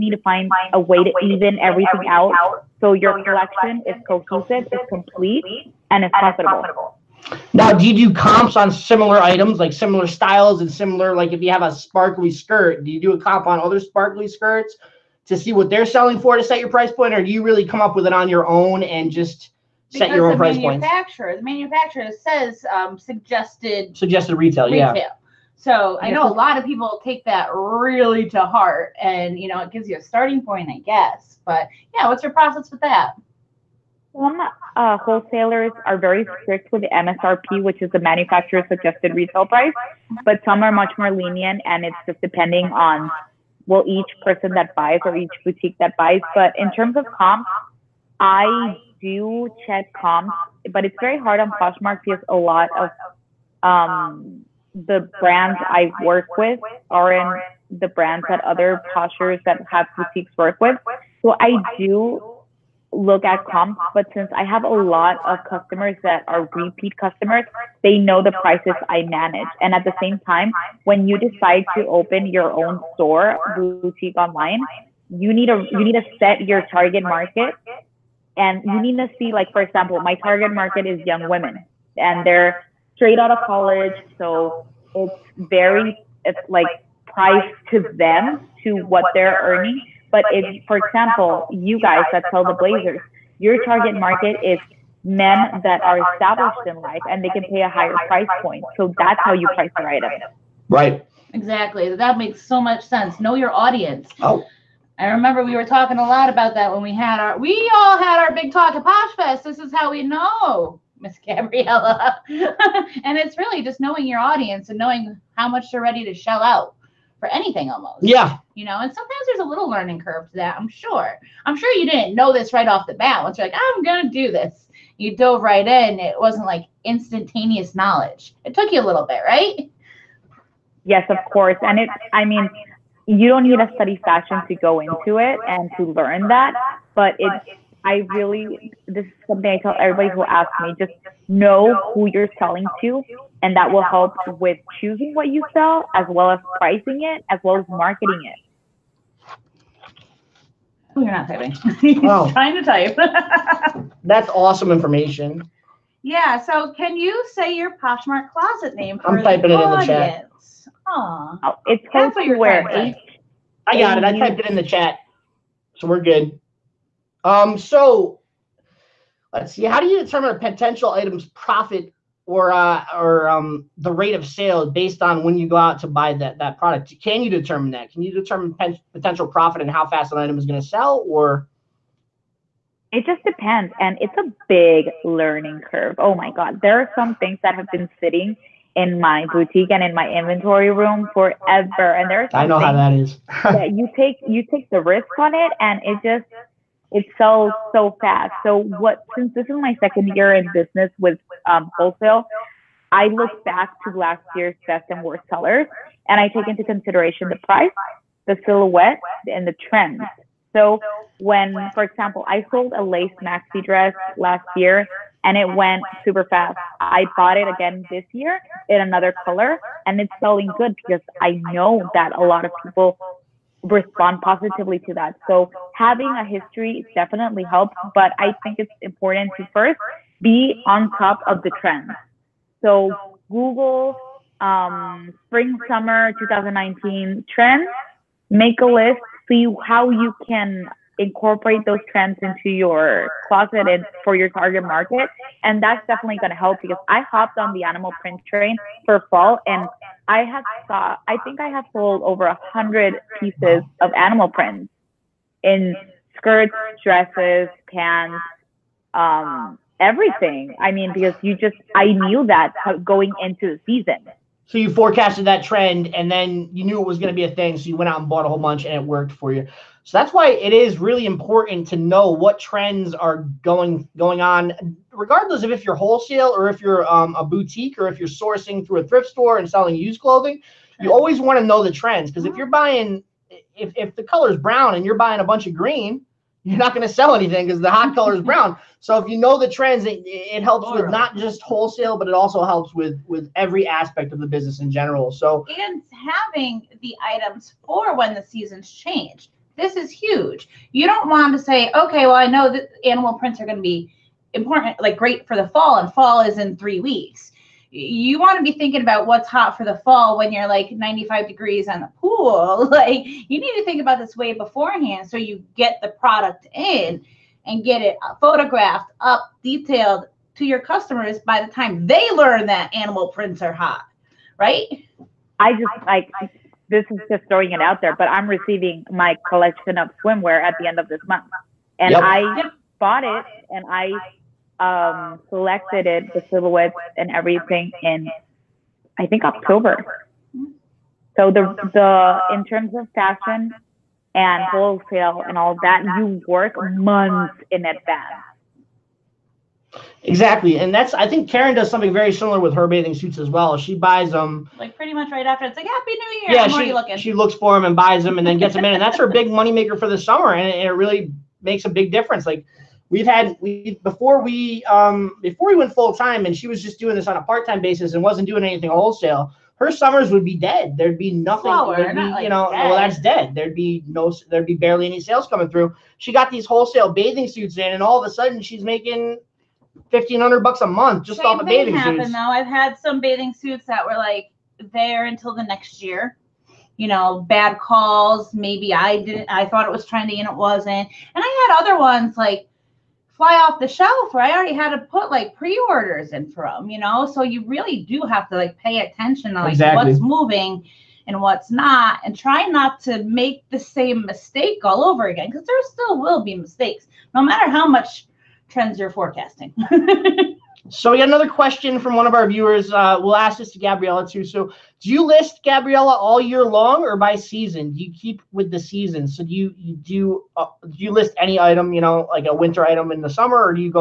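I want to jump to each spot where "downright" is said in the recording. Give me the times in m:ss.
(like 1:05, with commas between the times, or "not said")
not said.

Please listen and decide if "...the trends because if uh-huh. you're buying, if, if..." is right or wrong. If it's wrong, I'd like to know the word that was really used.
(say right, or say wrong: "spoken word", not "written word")
right.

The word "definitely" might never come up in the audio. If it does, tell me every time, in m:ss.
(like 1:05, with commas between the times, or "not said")
3:46, 4:05.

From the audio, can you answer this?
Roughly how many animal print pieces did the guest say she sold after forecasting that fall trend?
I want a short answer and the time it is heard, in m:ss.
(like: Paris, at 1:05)
over 100, at 4:12.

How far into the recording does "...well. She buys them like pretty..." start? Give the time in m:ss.
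5:53.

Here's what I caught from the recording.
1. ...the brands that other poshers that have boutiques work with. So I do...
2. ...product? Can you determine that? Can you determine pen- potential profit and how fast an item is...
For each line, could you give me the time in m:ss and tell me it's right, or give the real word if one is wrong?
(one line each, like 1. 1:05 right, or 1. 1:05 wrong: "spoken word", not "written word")
1. 0:57 right
2. 2:56 right.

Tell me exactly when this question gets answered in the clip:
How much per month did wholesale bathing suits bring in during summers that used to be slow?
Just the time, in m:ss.
6:19.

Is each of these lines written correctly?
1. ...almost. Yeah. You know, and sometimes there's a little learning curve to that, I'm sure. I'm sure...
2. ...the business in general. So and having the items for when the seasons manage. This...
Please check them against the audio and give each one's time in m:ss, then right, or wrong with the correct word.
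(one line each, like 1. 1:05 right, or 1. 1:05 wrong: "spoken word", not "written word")
1. 1:57 right
2. 4:54 wrong: "change", not "manage".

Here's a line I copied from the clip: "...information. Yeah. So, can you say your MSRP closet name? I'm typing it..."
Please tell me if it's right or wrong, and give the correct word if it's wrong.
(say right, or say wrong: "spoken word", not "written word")
wrong: "Poshmark", not "MSRP".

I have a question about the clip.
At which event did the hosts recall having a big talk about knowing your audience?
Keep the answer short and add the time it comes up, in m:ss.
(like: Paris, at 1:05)
Posh Fest, at 1:48.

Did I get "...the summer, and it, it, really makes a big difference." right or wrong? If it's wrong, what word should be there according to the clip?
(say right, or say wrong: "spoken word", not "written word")
right.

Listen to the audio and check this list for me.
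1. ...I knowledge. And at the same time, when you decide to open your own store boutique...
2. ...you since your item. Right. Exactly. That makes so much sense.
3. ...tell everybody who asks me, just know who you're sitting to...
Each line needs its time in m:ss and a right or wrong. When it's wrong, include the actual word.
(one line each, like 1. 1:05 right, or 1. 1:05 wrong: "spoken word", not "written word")
1. 1:08 wrong: "manage", not "knowledge"
2. 1:39 wrong: "price", not "since"
3. 2:19 wrong: "selling", not "sitting".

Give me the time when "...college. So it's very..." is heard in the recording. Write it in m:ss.
1:23.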